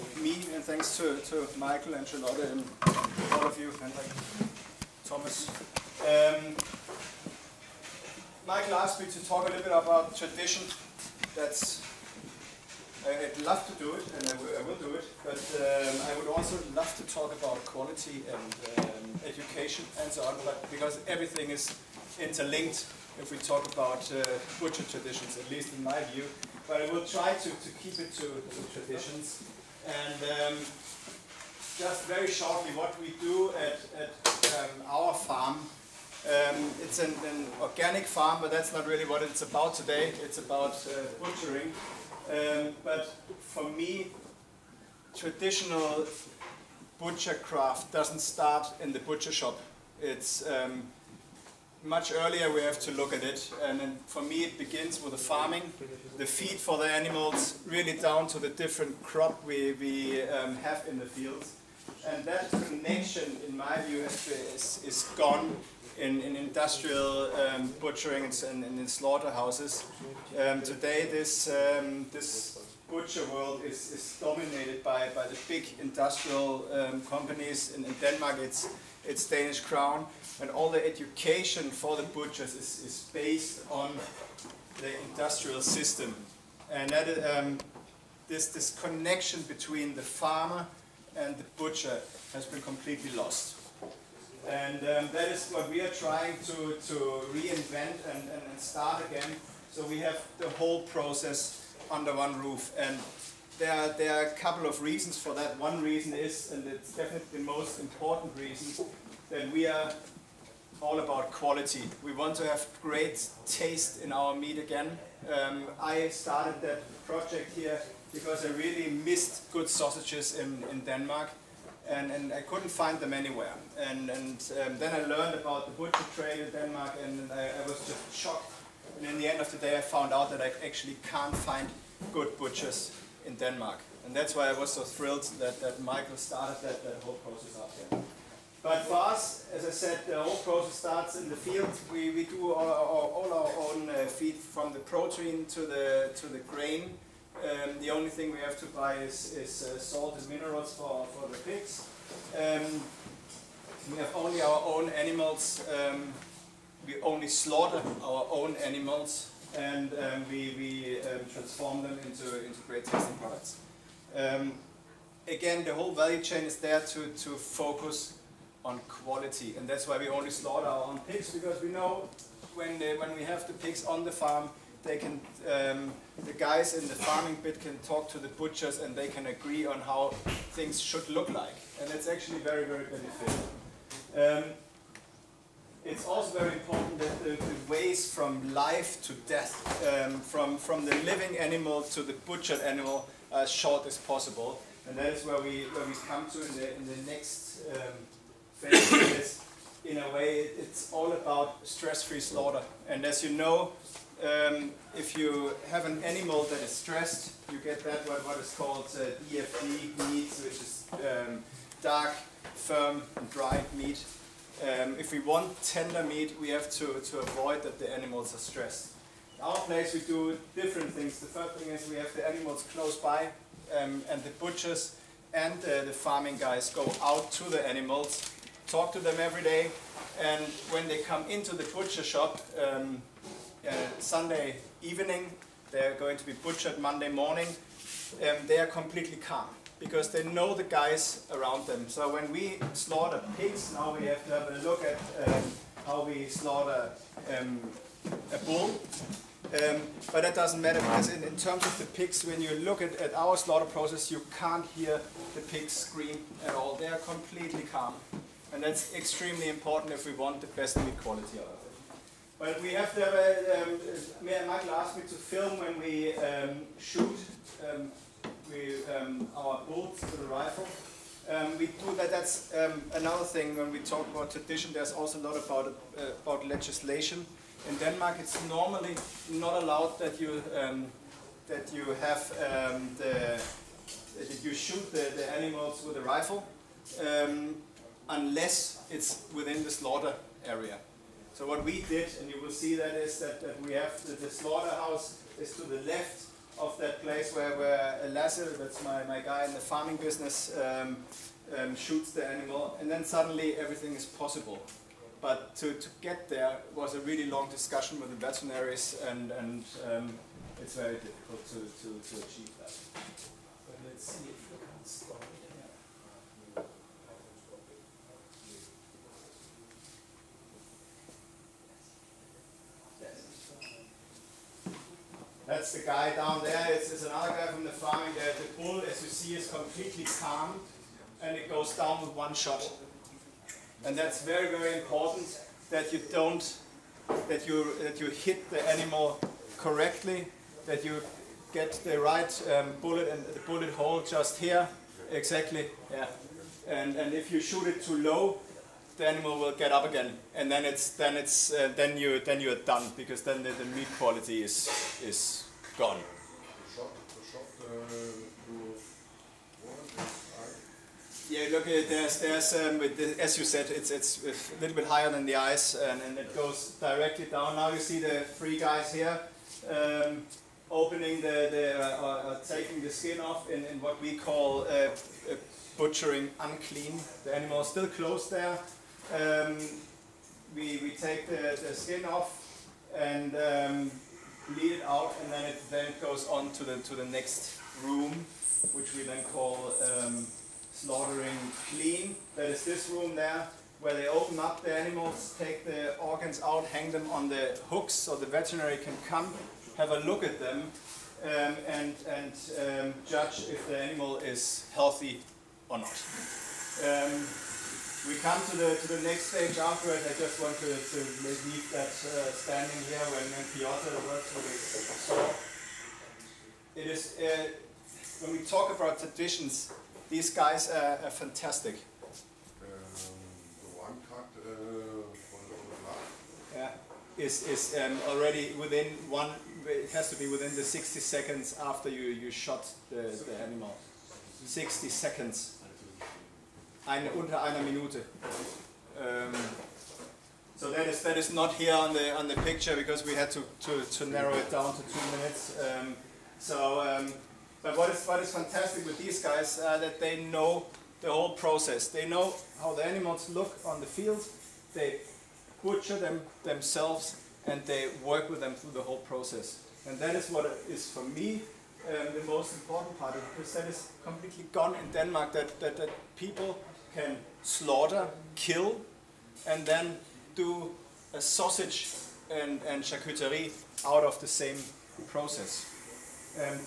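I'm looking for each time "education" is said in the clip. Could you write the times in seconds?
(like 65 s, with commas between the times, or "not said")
19 s, 80 s.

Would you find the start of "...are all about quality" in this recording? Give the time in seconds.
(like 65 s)
109 s.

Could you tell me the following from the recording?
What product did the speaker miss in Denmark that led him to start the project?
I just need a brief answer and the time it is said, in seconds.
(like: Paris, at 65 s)
Sausages, at 119 s.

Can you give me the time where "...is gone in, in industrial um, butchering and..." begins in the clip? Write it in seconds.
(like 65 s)
64 s.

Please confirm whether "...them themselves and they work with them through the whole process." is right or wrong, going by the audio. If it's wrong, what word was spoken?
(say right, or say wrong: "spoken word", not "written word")
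right.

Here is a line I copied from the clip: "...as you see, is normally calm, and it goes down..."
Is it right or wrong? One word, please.
wrong.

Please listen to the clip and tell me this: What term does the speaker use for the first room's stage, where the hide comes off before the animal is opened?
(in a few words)
Butchering unclean.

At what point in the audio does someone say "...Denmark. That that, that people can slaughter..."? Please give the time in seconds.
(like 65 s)
464 s.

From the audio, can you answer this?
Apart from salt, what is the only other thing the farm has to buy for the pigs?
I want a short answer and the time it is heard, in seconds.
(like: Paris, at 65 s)
Minerals, at 150 s.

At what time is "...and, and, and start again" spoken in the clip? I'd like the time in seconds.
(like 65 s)
98 s.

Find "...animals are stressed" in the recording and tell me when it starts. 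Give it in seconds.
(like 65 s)
217 s.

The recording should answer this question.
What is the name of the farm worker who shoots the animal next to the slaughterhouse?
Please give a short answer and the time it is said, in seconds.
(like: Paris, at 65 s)
Lasse, at 298 s.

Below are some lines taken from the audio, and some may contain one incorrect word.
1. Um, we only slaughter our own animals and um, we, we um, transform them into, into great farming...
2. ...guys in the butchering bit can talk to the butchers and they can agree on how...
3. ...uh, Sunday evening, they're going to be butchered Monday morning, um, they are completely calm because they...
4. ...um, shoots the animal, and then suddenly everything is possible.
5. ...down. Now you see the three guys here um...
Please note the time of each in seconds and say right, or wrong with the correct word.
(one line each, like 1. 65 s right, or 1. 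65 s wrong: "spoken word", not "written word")
1. 155 s wrong: "tasting", not "farming"
2. 176 s wrong: "farming", not "butchering"
3. 233 s right
4. 301 s right
5. 367 s right.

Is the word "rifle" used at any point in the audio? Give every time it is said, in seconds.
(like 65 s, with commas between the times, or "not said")
270 s, 286 s.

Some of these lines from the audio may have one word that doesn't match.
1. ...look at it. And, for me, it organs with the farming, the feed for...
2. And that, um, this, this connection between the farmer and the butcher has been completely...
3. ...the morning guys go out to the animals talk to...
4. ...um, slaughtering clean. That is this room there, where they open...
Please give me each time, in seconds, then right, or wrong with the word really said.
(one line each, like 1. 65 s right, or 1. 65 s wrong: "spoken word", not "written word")
1. 52 s wrong: "begins", not "organs"
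2. 86 s right
3. 225 s wrong: "farming", not "morning"
4. 389 s right.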